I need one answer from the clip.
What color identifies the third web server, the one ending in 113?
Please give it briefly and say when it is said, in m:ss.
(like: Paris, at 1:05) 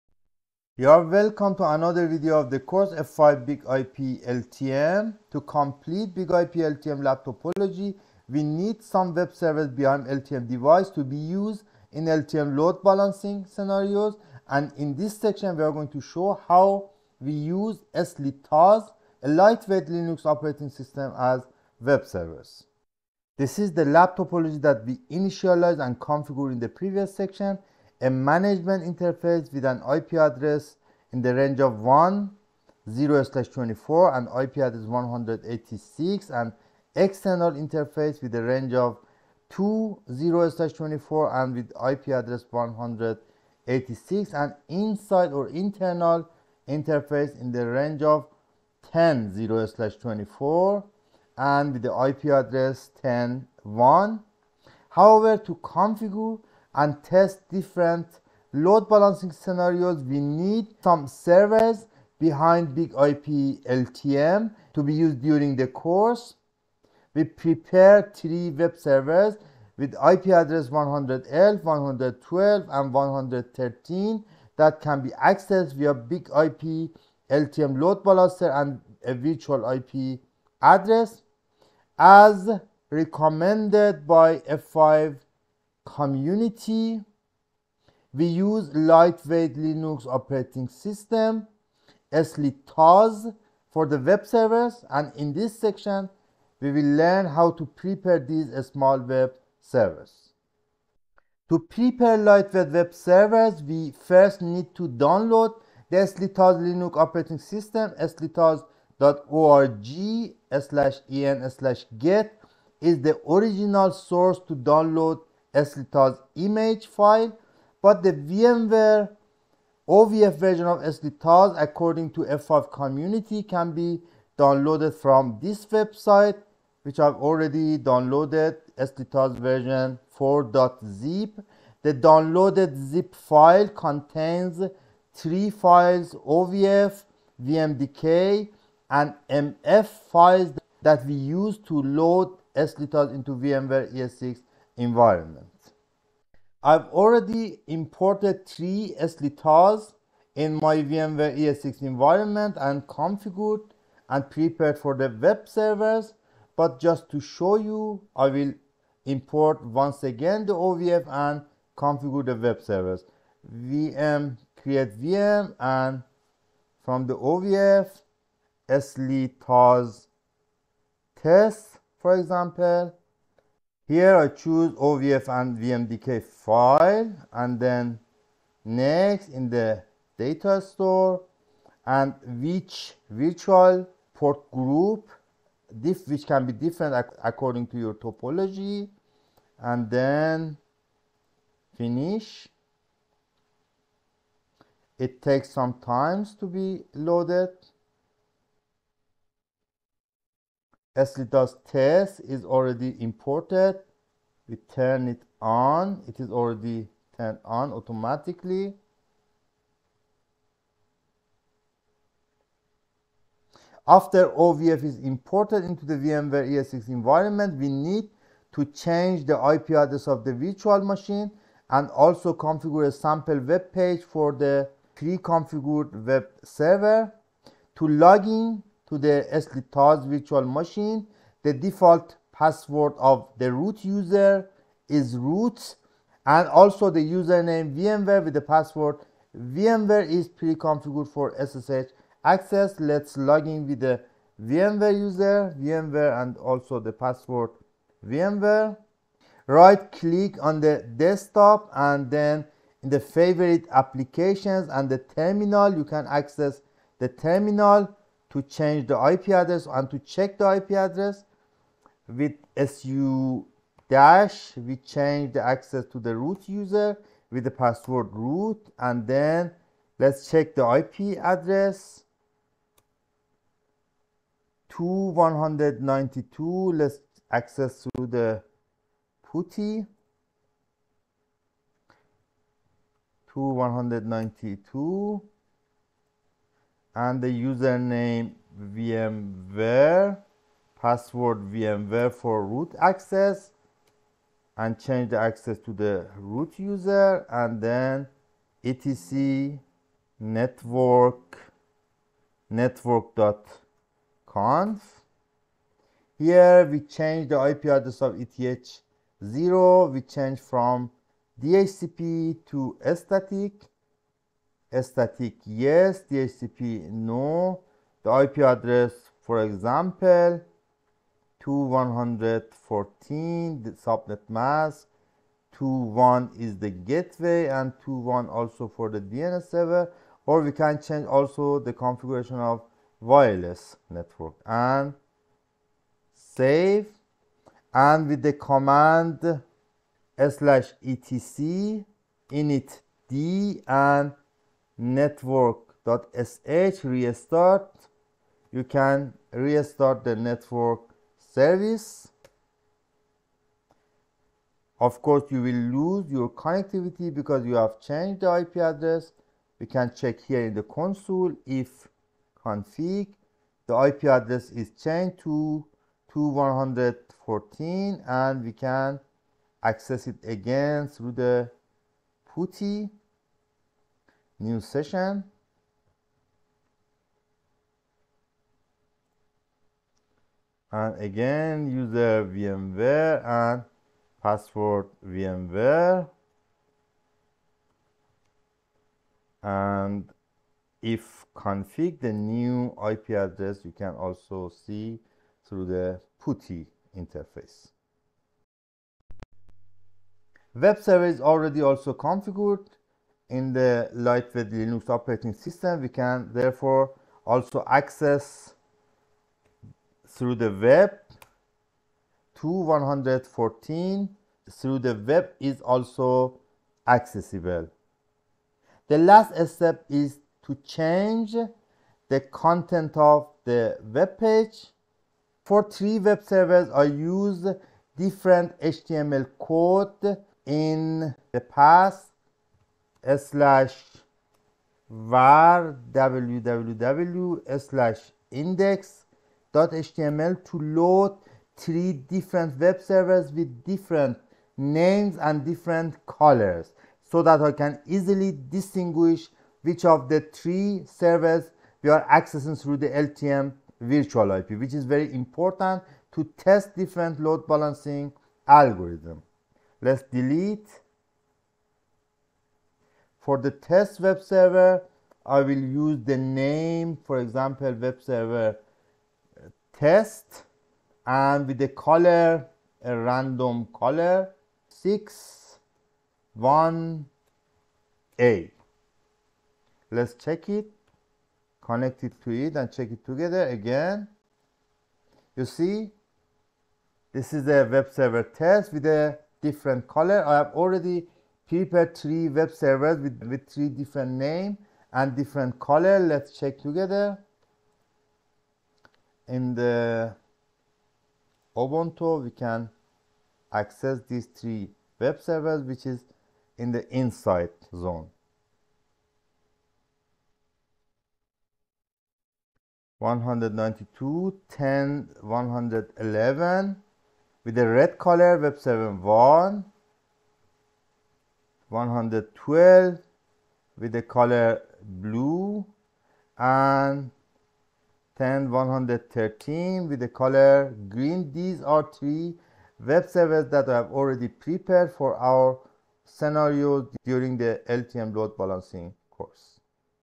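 green, at 8:50.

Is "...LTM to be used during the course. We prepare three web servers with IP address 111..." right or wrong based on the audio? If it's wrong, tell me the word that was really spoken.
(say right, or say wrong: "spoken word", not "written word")
right.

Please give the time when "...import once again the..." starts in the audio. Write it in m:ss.
2:39.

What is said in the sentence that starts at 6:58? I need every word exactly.
The last step is to change the content of the web page.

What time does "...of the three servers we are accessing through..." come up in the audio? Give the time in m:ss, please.
7:29.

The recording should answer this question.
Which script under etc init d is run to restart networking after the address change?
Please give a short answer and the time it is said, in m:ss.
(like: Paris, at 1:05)
network.sh, at 5:44.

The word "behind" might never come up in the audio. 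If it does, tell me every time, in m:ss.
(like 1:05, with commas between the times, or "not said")
0:09, 1:02.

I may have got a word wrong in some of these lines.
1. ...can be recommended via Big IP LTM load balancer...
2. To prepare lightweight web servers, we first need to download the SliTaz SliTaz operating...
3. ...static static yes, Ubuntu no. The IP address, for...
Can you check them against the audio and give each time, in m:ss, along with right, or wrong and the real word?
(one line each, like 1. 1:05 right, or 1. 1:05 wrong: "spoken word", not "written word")
1. 1:14 wrong: "accessed", not "recommended"
2. 1:41 wrong: "Linux", not "SliTaz"
3. 5:12 wrong: "DHCP", not "Ubuntu".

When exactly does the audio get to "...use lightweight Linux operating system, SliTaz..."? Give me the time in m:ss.
1:28.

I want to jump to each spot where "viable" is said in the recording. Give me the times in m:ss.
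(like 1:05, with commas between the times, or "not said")
not said.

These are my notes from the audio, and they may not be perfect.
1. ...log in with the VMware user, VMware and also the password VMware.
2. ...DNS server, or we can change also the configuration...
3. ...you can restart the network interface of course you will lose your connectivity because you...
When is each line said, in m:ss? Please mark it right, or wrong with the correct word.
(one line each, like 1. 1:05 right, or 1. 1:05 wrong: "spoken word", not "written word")
1. 4:03 right
2. 5:29 right
3. 5:48 wrong: "service", not "interface".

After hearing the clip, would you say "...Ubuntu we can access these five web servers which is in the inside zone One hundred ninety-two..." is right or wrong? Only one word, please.
wrong.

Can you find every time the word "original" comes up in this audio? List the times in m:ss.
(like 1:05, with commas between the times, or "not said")
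1:53.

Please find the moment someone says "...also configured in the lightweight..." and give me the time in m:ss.
6:41.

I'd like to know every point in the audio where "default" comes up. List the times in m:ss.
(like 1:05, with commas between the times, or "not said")
3:51.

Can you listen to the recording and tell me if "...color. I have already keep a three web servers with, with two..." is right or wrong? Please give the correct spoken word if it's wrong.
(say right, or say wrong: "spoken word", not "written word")
wrong: "three", not "two".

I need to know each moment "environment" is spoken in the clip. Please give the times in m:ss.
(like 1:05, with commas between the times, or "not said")
2:24, 2:31, 3:36.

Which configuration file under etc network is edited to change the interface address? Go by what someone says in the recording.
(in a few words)
network.conf.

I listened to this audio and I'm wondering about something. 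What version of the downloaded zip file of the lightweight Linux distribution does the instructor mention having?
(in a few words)
version 4.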